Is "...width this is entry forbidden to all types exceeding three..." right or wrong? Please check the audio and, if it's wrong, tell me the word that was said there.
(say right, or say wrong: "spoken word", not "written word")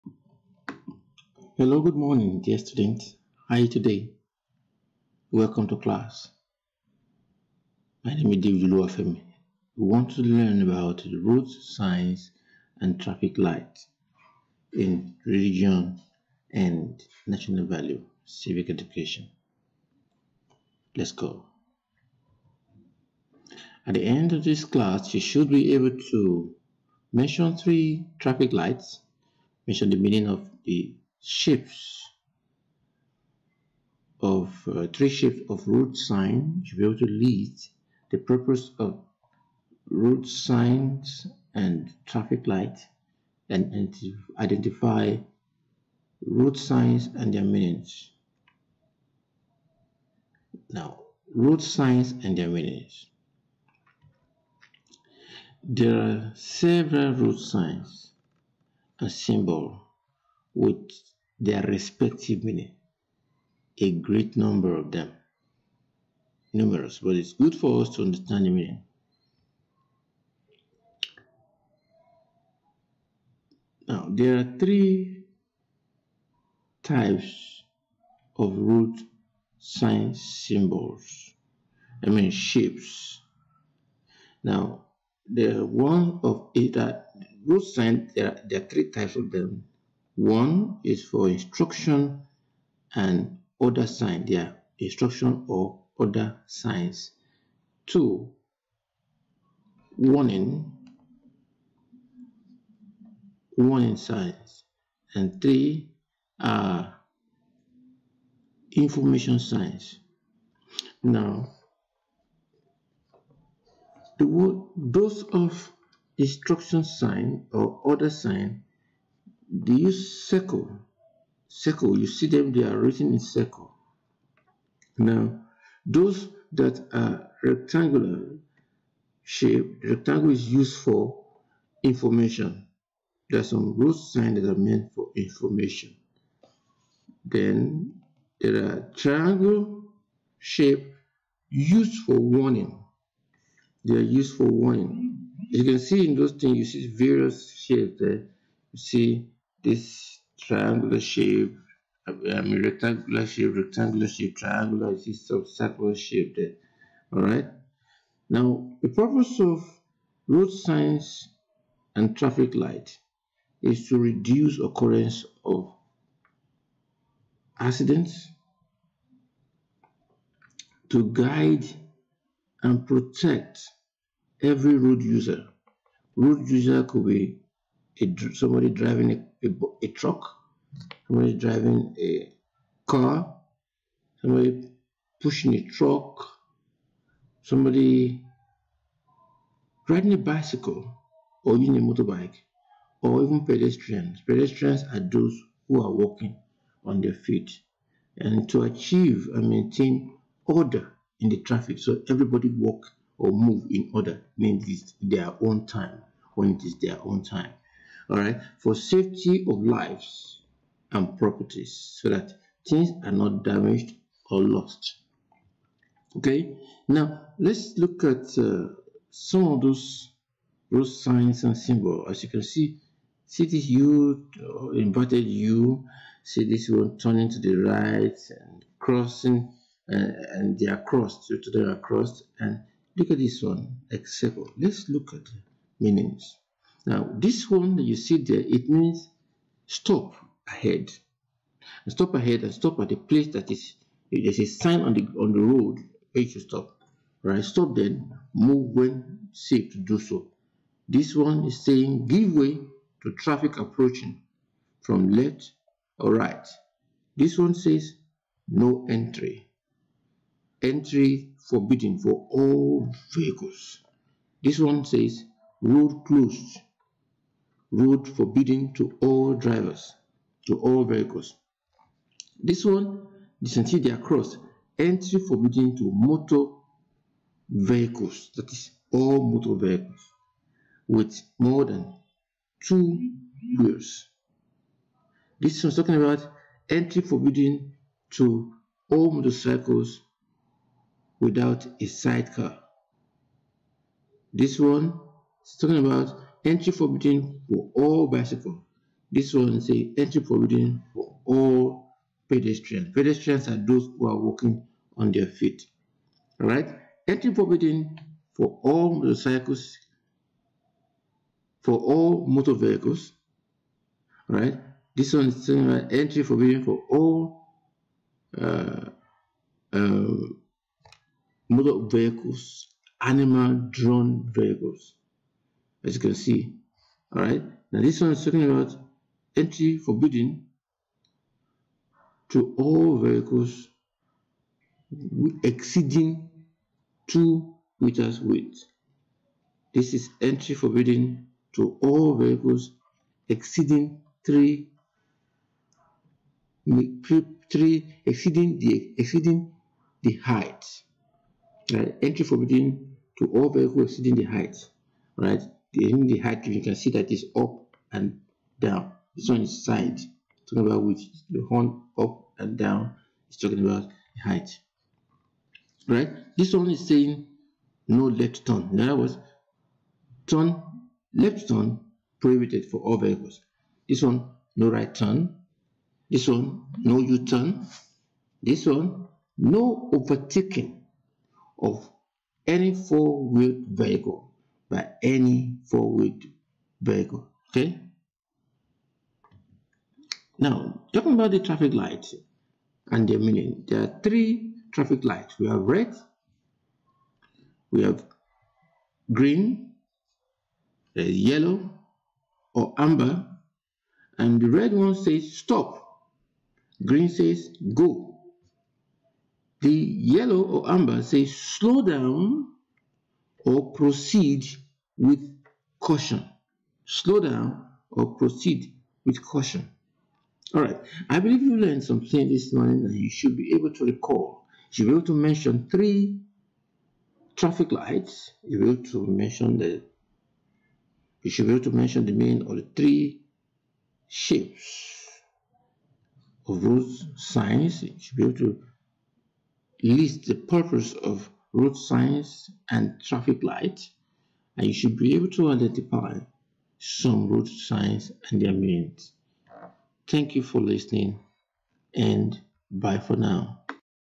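wrong: "vehicles", not "types".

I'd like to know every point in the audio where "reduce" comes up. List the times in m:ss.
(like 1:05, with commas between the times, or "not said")
2:43.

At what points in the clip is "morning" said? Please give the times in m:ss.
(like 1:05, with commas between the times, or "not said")
0:01, 7:02.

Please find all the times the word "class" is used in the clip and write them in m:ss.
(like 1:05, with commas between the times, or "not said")
0:05, 0:24.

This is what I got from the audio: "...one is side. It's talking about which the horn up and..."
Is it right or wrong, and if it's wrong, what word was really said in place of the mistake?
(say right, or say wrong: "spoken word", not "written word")
right.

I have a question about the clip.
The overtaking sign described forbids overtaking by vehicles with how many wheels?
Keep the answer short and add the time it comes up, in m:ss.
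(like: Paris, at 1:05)
4, at 6:22.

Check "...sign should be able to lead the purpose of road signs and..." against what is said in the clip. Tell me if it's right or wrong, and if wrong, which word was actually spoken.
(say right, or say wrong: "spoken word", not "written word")
right.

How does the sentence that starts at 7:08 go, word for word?
You will to mention the you should be able to mention the main or the three shapes of those signs.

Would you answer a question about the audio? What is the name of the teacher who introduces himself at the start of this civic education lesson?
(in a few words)
David Luafemi.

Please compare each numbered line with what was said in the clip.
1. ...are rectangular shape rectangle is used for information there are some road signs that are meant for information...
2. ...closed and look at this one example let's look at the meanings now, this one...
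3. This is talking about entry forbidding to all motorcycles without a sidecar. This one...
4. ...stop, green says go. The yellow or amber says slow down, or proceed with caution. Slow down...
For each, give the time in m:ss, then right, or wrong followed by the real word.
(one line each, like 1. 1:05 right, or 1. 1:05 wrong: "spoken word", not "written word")
1. 2:06 right
2. 3:51 wrong: "crossed", not "closed"
3. 4:45 right
4. 6:45 right.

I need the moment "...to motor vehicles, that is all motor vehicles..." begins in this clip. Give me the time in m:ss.
4:35.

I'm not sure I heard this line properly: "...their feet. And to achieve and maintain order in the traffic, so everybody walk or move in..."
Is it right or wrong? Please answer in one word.
right.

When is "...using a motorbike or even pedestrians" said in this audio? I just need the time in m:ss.
3:11.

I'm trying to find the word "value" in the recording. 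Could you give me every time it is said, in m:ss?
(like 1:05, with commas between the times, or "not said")
0:17.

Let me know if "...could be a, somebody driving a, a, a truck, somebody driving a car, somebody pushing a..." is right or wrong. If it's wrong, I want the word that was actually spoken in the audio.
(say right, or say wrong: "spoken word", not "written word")
right.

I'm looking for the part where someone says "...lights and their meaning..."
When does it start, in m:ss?
6:31.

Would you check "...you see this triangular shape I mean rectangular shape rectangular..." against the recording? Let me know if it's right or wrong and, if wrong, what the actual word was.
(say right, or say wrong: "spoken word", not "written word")
right.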